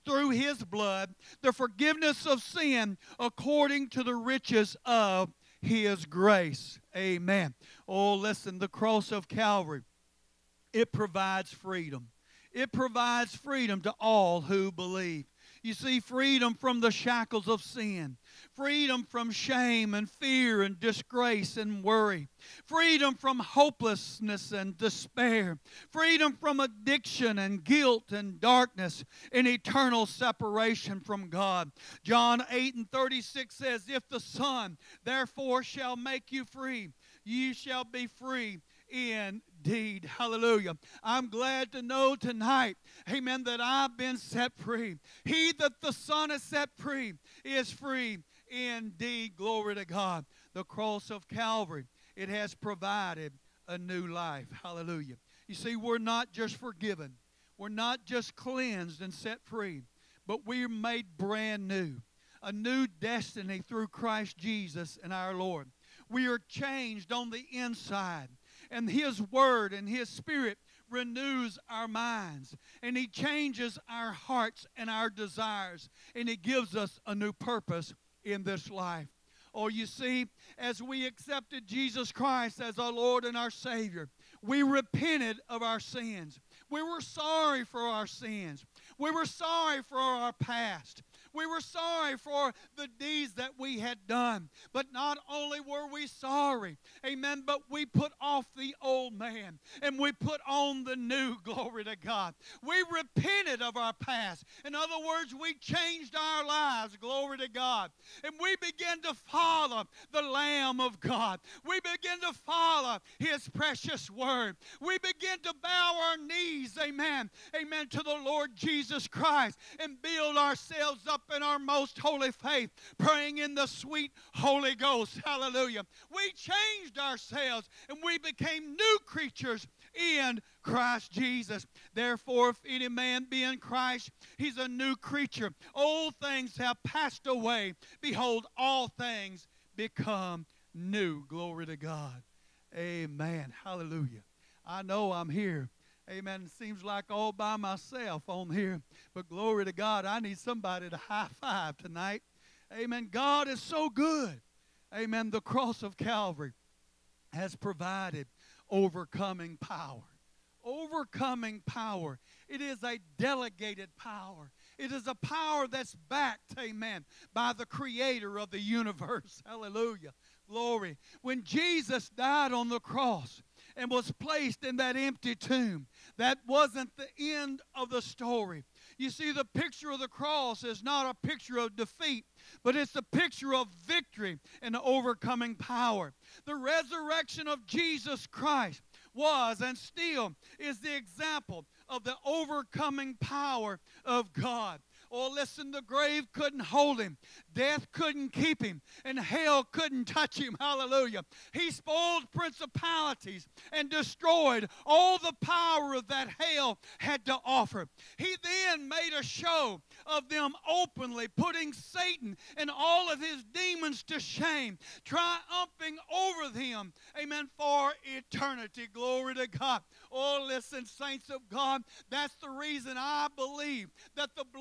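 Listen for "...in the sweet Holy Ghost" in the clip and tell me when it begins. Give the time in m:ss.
2:03.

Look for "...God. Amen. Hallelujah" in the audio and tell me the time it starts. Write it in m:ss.
2:21.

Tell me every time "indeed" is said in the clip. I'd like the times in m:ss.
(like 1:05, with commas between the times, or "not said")
0:39, 0:48.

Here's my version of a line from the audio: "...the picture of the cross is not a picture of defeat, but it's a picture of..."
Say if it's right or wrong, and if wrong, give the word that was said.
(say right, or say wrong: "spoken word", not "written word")
right.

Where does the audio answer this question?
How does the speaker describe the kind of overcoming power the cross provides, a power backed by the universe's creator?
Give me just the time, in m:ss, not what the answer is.
2:43.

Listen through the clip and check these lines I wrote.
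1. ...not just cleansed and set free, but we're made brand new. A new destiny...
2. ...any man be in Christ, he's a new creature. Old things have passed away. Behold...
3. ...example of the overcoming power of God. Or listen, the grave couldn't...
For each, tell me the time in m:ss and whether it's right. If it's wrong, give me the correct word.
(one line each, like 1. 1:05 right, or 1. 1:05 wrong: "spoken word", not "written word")
1. 0:57 right
2. 2:12 right
3. 3:10 right.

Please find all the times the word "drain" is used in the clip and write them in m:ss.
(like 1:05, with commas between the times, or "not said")
not said.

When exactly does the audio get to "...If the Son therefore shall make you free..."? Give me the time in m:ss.
0:33.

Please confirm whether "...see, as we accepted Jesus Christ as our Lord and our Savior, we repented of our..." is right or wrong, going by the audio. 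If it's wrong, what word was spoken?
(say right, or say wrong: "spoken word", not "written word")
right.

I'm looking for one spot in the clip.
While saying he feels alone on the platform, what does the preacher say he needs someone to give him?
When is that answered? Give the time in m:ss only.
2:30.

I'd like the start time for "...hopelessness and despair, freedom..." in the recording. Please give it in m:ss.
0:23.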